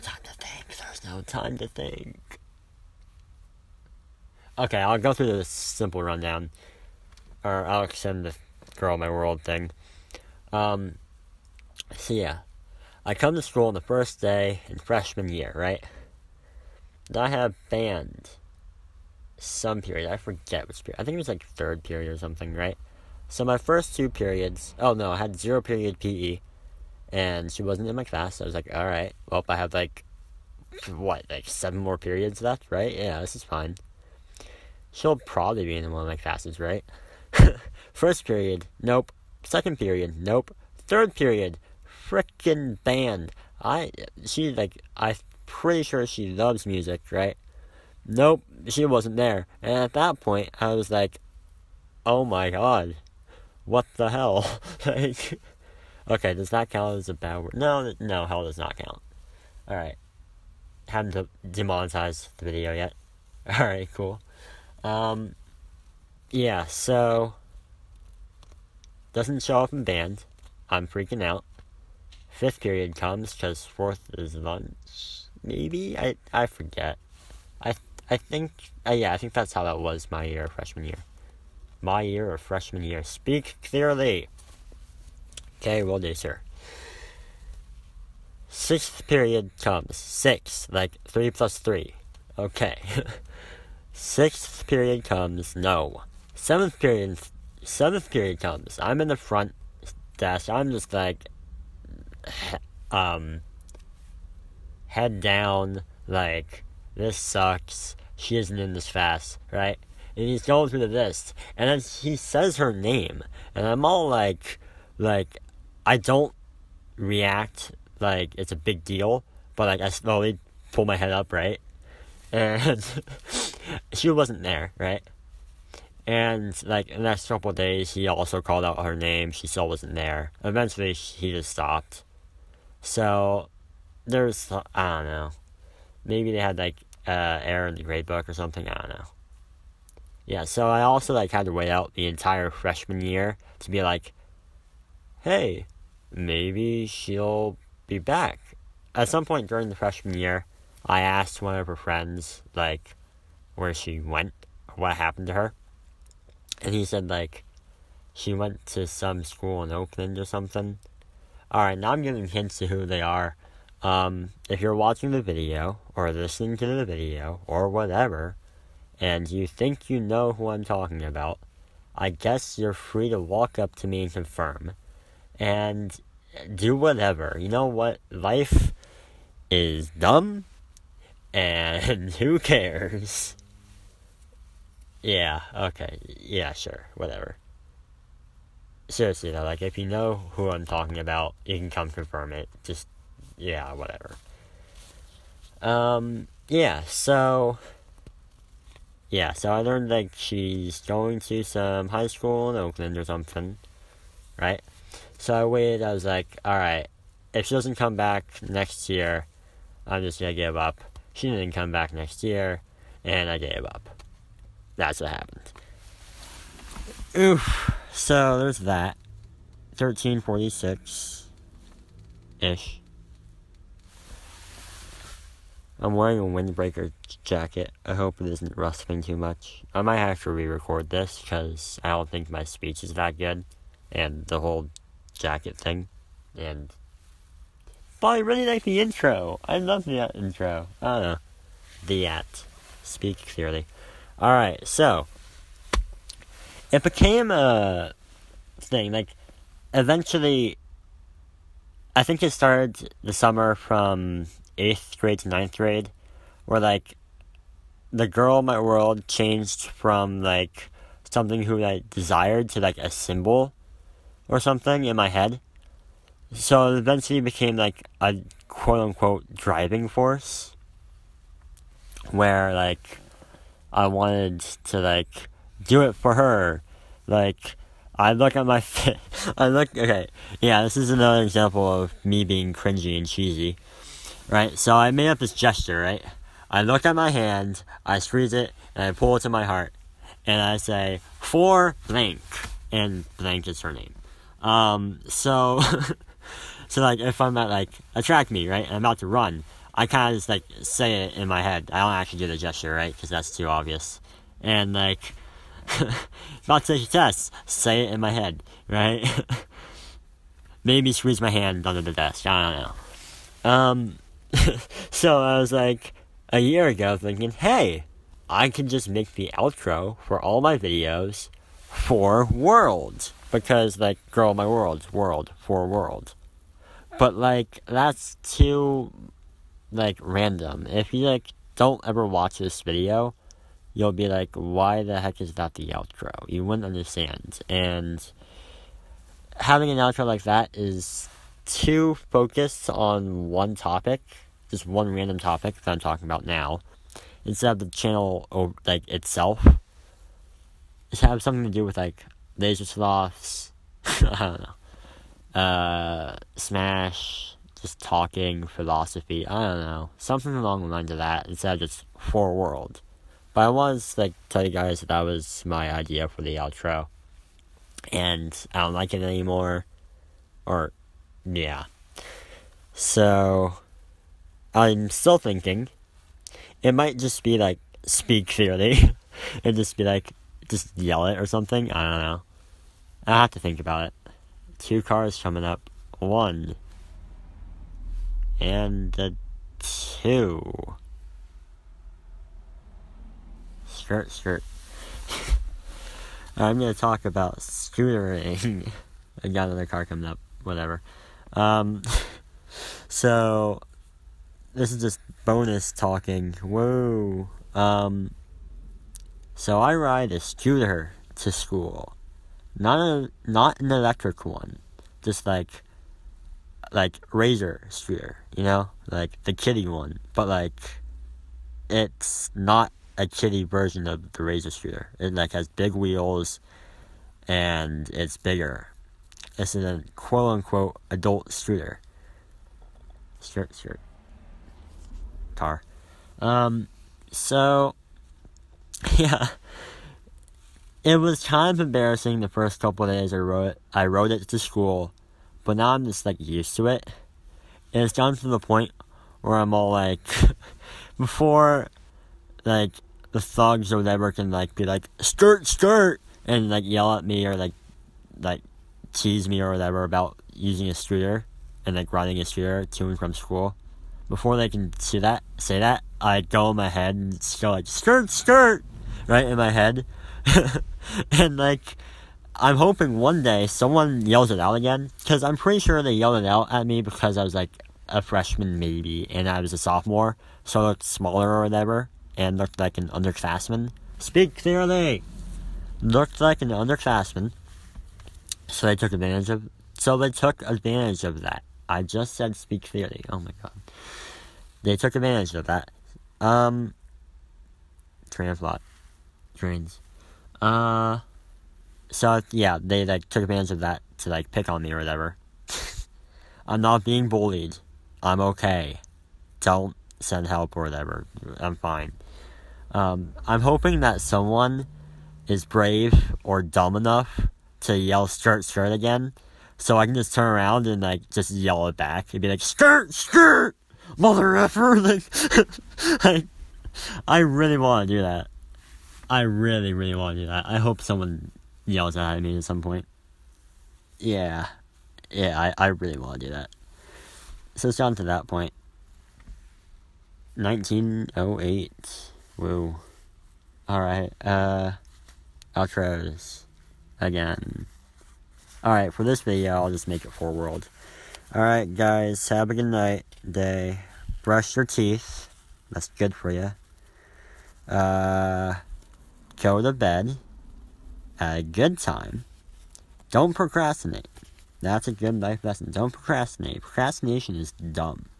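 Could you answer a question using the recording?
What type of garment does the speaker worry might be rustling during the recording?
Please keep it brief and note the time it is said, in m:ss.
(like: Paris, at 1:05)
Windbreaker jacket, at 3:46.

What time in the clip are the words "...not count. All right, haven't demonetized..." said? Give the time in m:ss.
0:58.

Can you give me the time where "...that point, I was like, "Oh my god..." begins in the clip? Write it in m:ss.
0:49.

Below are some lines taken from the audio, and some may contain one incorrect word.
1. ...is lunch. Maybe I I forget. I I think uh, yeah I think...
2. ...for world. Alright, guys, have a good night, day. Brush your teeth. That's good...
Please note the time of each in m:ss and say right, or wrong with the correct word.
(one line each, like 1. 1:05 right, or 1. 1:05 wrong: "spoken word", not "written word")
1. 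1:14 right
2. 9:10 right.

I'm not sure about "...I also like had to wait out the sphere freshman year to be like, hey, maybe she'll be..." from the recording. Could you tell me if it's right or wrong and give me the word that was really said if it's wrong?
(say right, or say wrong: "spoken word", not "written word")
wrong: "entire", not "sphere".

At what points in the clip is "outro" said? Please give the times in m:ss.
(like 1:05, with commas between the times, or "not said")
5:19, 5:35, 5:39, 6:06, 9:05.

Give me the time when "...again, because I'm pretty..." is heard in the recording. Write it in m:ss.
7:54.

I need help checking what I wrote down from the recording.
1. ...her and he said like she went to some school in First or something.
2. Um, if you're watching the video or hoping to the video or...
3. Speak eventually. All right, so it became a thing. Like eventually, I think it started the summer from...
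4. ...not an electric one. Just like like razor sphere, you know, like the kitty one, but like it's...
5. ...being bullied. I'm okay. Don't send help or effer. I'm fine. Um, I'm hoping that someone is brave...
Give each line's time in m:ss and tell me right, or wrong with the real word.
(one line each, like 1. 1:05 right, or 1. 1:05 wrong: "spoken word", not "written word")
1. 2:35 wrong: "Oakland", not "First"
2. 2:43 wrong: "listening", not "hoping"
3. 4:02 wrong: "clearly", not "eventually"
4. 6:53 right
5. 8:26 wrong: "whatever", not "effer".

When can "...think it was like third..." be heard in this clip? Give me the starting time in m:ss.
0:21.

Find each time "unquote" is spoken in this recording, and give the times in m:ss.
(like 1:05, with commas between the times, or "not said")
4:28, 7:10.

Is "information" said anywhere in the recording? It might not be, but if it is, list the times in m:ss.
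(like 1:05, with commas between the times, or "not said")
not said.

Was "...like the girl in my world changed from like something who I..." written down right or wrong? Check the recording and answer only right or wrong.
right.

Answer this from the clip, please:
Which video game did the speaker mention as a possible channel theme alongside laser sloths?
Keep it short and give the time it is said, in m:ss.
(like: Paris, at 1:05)
Smash, at 5:56.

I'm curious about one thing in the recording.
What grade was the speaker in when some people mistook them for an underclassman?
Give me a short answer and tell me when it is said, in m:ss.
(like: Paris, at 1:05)
Sophomore, at 7:59.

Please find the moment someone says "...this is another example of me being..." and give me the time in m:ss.
4:40.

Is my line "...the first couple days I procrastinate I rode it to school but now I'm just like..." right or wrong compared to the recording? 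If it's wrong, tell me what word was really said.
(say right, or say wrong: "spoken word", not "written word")
wrong: "wrote", not "procrastinate".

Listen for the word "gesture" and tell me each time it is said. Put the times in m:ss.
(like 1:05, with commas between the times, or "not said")
4:45, 5:02.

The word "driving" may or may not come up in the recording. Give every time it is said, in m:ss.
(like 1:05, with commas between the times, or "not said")
4:29.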